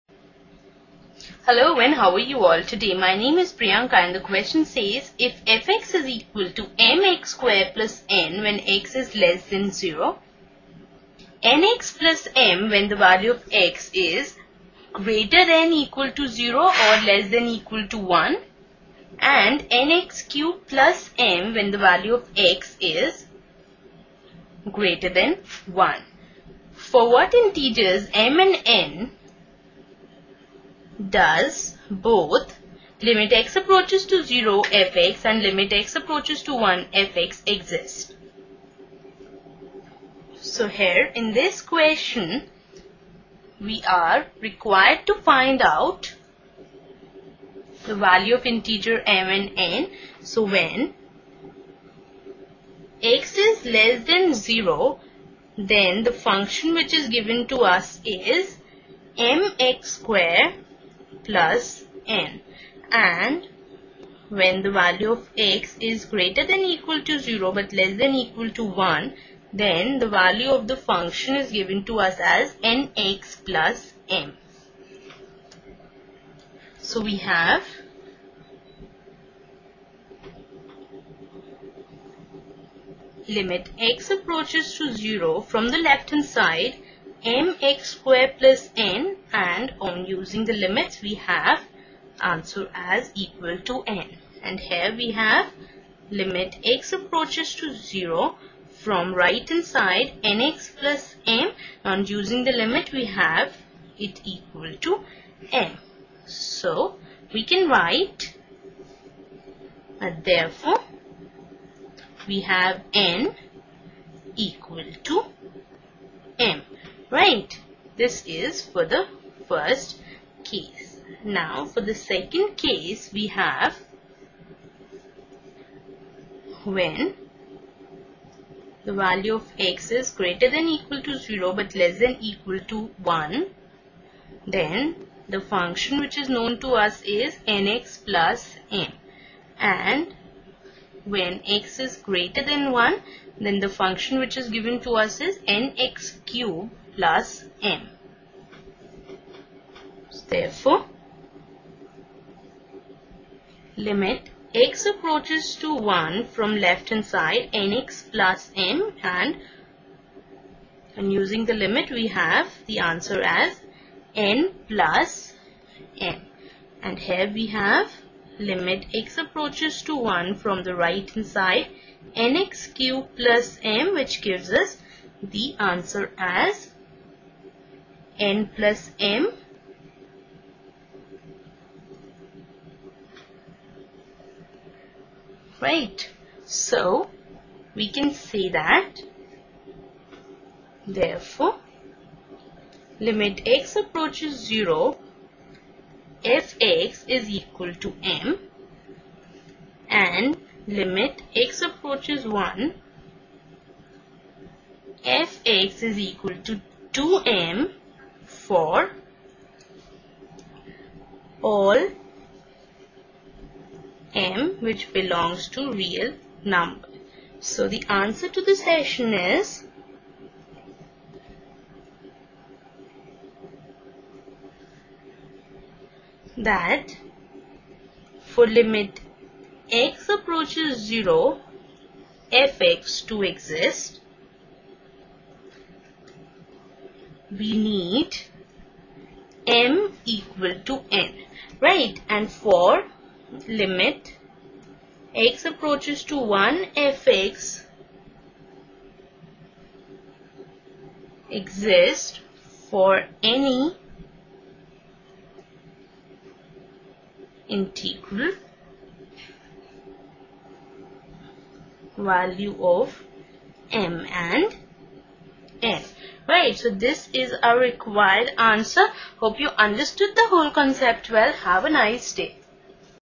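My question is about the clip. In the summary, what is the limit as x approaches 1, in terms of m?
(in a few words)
2m.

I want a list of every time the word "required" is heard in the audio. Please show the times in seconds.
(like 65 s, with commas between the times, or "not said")
44 s, 267 s.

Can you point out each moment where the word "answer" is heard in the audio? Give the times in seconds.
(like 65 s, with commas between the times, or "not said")
92 s, 162 s, 175 s, 217 s, 268 s.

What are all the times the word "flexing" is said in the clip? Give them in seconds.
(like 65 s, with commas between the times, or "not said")
not said.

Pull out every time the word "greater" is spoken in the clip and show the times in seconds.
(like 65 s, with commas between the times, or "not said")
14 s, 24 s, 66 s, 130 s, 142 s.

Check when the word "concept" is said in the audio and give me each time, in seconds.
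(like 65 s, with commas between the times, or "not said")
270 s.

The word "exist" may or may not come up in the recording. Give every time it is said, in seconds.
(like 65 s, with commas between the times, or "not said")
37 s, 233 s, 251 s.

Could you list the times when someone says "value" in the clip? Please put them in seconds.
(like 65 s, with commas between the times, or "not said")
12 s, 21 s, 47 s, 64 s, 70 s, 128 s, 261 s.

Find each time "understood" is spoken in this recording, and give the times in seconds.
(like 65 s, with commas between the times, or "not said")
269 s.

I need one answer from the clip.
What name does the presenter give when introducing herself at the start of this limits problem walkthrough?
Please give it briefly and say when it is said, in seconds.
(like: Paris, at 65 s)
Priyanka, at 3 s.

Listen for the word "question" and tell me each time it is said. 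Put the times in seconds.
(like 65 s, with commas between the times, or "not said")
4 s, 41 s.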